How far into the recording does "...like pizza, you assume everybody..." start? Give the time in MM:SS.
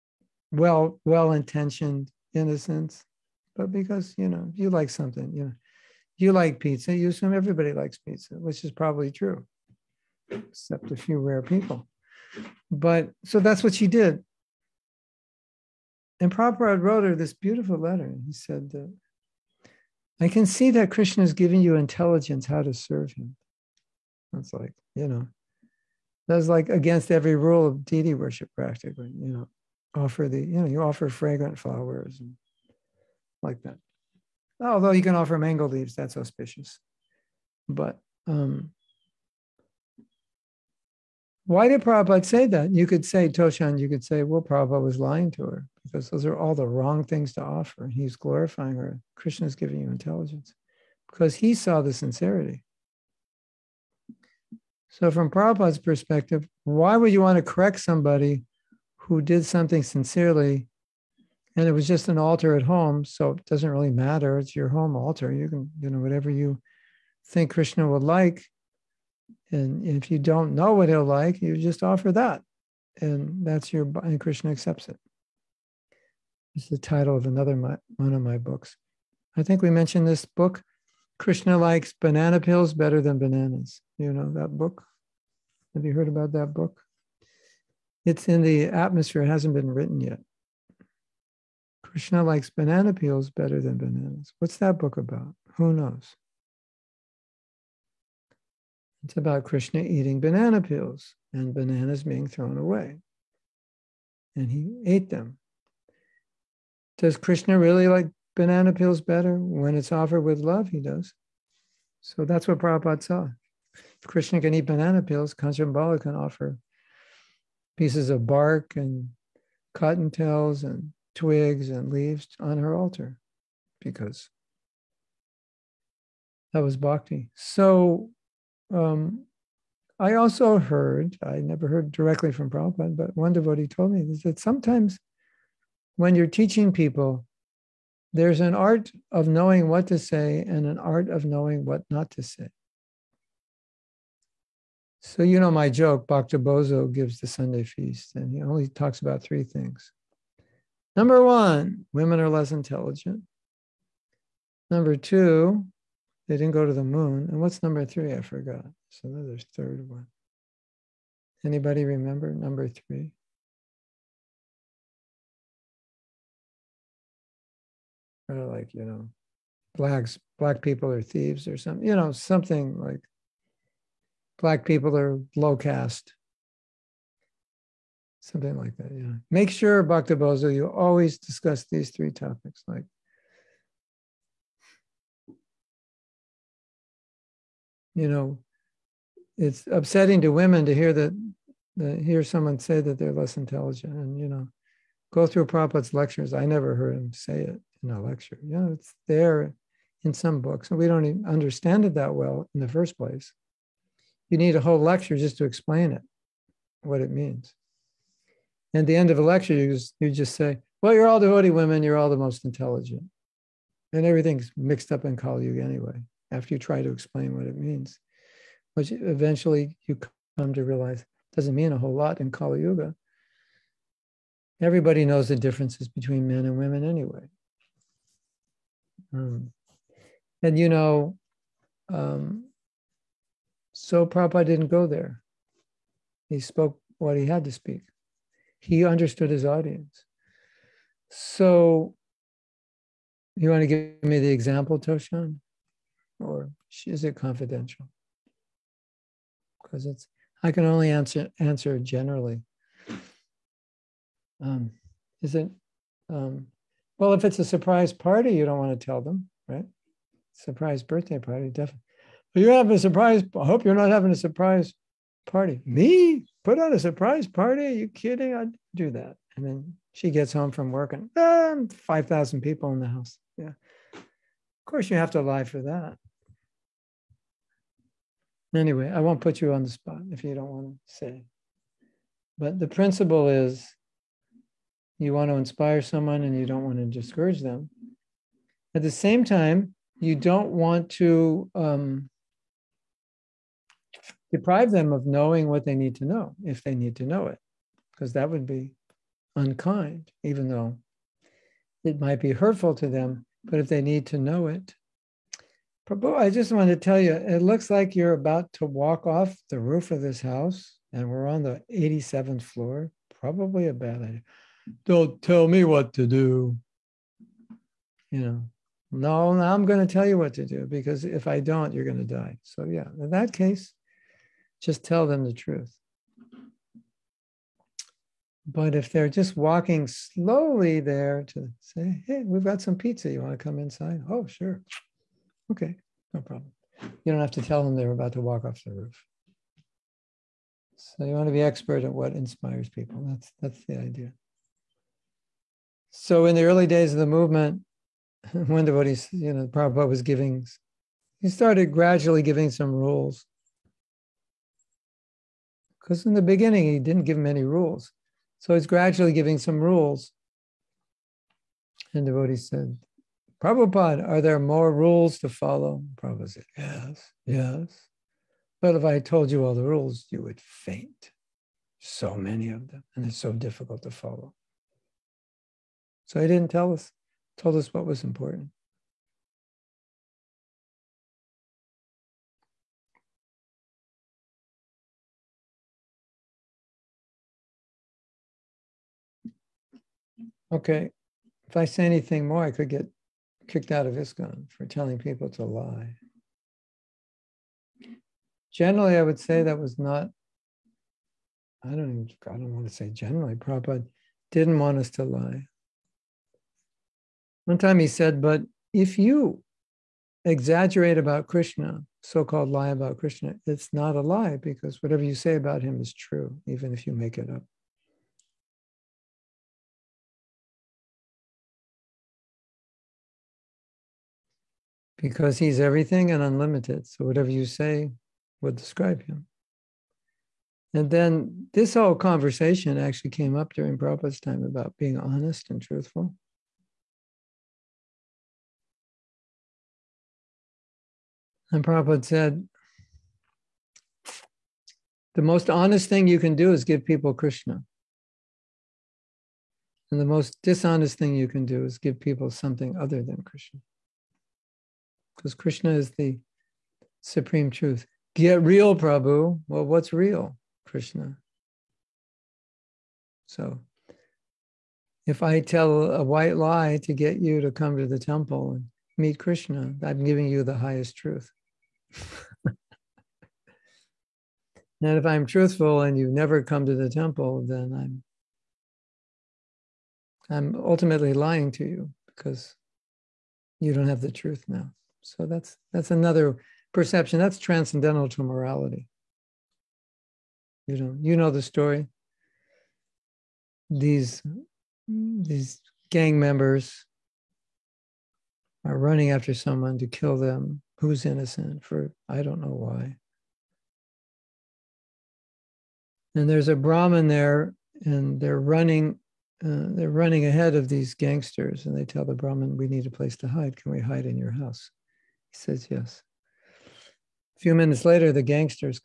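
00:06.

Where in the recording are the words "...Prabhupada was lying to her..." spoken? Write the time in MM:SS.
00:44.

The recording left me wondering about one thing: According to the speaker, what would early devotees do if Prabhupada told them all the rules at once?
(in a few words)
faint.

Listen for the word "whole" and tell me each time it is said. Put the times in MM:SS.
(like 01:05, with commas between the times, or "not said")
03:24, 03:41, 07:11.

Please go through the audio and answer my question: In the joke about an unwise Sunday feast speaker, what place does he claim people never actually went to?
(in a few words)
the moon.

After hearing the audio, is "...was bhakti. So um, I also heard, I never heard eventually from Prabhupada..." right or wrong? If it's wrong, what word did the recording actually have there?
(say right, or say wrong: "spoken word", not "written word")
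wrong: "directly", not "eventually".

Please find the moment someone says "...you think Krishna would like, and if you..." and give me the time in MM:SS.
01:06.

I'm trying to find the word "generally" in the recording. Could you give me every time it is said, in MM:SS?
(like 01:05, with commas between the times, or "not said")
04:11, 06:38, 06:42.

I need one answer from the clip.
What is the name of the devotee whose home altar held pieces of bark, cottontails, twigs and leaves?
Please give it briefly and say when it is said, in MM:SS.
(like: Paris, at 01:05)
Kanchanbala, at 01:55.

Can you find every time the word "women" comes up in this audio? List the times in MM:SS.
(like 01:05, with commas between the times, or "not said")
02:31, 03:10, 03:31, 03:46.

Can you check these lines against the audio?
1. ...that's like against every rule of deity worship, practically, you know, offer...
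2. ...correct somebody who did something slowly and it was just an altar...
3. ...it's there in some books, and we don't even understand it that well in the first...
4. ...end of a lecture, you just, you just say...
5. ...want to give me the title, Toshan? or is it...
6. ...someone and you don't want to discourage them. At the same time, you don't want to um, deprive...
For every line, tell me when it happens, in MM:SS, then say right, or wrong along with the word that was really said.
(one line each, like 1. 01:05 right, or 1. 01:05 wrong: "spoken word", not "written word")
1. 00:26 right
2. 00:57 wrong: "sincerely", not "slowly"
3. 03:18 right
4. 03:28 right
5. 04:03 wrong: "example", not "title"
6. 04:45 right.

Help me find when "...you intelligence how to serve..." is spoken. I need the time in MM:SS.
00:21.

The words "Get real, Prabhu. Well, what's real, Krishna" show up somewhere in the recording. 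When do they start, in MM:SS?
07:38.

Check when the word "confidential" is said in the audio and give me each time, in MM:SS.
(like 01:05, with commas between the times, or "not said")
04:07.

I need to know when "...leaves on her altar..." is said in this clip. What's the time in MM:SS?
02:01.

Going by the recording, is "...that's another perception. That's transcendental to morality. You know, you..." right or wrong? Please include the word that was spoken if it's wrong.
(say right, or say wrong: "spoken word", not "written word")
right.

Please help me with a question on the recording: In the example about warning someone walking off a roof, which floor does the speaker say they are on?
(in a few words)
87th floor.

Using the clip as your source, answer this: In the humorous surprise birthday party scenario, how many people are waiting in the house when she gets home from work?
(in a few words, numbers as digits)
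5,000.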